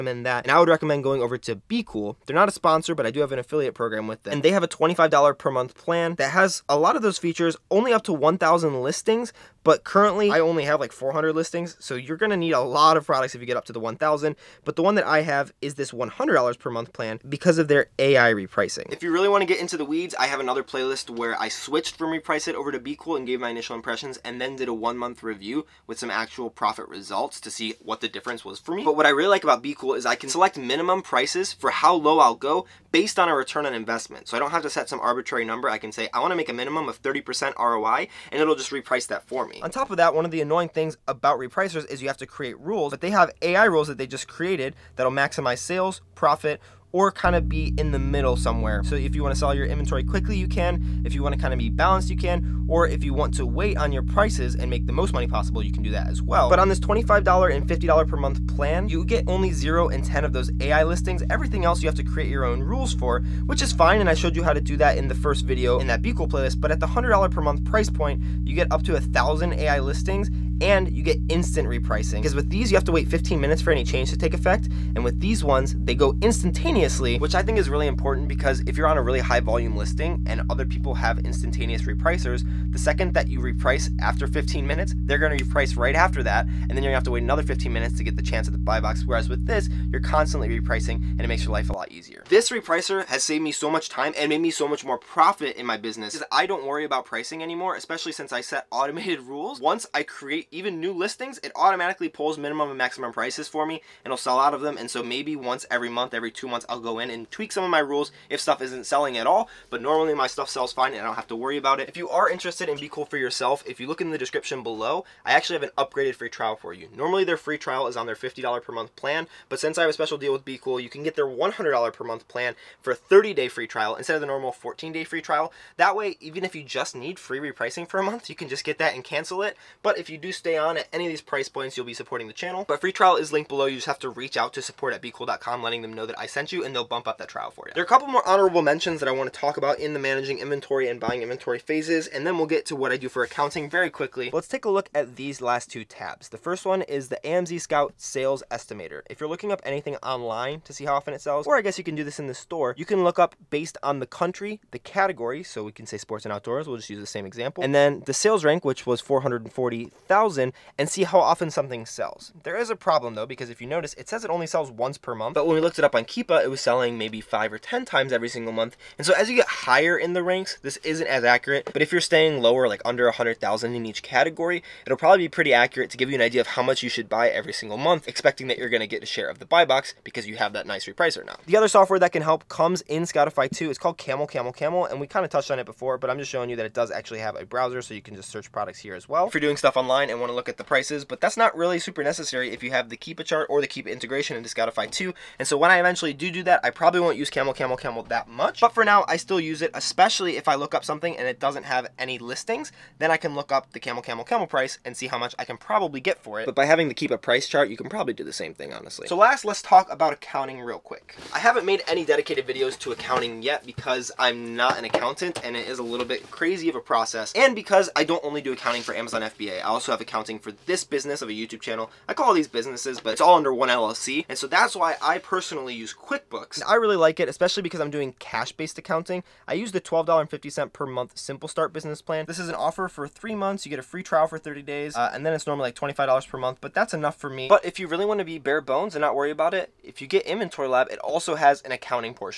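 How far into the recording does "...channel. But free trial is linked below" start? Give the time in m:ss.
2:12.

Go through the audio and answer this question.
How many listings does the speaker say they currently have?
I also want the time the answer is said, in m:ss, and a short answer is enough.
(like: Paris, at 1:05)
400, at 0:10.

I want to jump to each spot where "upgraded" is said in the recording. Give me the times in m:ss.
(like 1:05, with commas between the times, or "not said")
1:55.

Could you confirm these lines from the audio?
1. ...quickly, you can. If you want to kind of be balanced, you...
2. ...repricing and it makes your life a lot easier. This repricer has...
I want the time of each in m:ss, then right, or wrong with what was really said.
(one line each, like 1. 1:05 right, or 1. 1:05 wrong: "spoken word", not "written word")
1. 0:50 right
2. 1:30 right.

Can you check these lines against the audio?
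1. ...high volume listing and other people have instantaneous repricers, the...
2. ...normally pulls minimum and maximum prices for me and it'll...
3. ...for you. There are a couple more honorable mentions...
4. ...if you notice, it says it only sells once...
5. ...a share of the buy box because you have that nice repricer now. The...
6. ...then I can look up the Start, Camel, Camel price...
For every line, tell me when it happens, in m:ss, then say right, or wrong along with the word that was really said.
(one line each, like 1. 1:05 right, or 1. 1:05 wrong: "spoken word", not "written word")
1. 1:19 right
2. 1:41 wrong: "automatically", not "normally"
3. 2:17 right
4. 2:43 right
5. 2:59 right
6. 3:22 wrong: "Camel", not "Start".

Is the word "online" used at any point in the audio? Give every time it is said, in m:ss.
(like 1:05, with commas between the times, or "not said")
2:29, 3:09.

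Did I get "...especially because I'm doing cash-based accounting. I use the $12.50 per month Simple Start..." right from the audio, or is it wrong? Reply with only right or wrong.
right.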